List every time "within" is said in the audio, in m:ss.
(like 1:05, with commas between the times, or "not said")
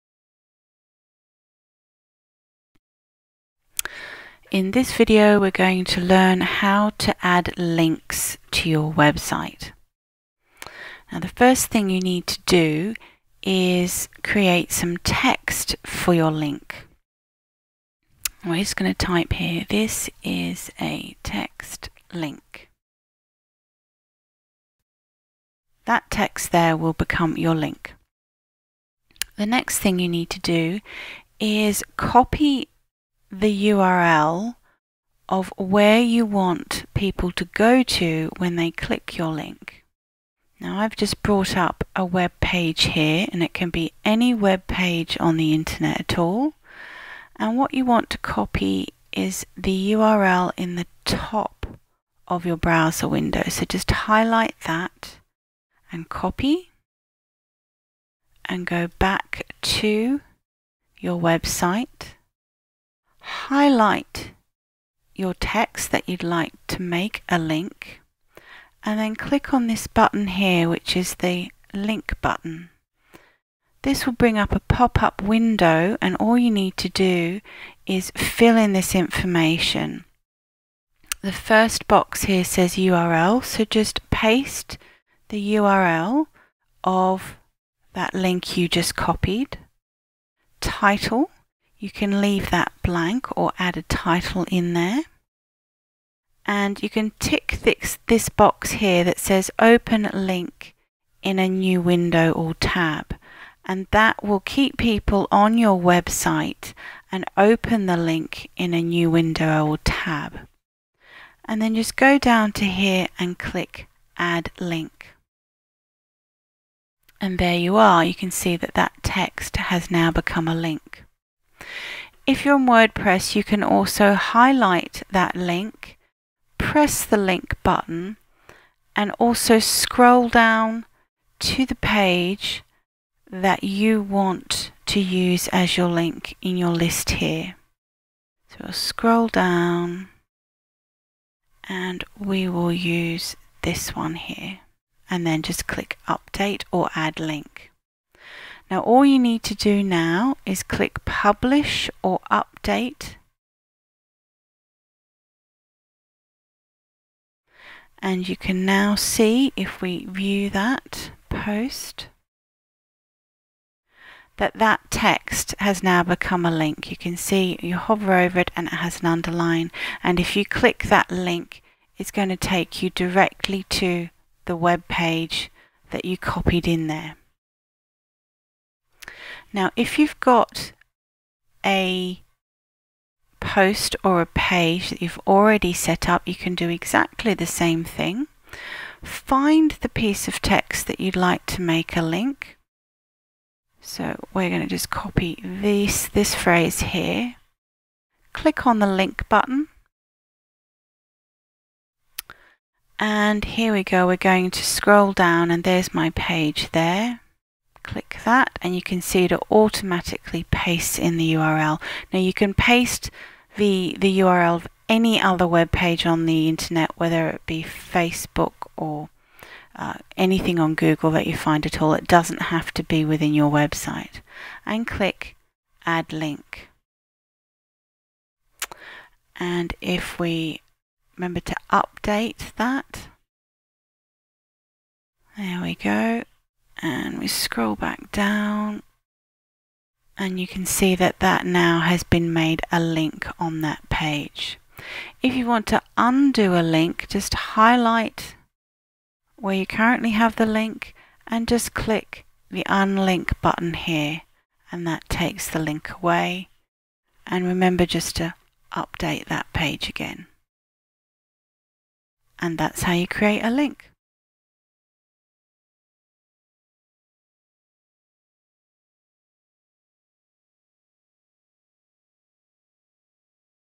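3:43.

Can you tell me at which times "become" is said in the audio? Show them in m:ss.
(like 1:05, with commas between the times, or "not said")
0:26, 2:00, 2:46.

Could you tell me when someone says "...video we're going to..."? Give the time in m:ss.
0:04.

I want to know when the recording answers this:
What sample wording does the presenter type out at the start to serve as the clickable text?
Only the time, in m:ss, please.
0:19.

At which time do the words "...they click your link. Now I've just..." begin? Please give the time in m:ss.
0:38.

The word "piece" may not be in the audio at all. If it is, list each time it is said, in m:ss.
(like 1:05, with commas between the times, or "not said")
3:09.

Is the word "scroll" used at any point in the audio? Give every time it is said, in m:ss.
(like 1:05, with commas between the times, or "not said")
2:09, 2:18, 3:24, 3:57.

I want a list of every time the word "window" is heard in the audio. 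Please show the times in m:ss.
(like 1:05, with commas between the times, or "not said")
0:53, 1:15, 1:41, 1:49.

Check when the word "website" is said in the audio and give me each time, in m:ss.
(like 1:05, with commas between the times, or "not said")
0:08, 1:01, 1:45, 3:43.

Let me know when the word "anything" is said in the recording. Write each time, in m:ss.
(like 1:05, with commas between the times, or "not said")
3:40.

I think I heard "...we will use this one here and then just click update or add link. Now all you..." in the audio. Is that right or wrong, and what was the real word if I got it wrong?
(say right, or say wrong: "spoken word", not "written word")
right.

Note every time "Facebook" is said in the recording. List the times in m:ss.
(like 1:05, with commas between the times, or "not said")
3:37.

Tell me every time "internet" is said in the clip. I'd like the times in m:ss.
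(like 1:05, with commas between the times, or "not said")
0:45, 3:36.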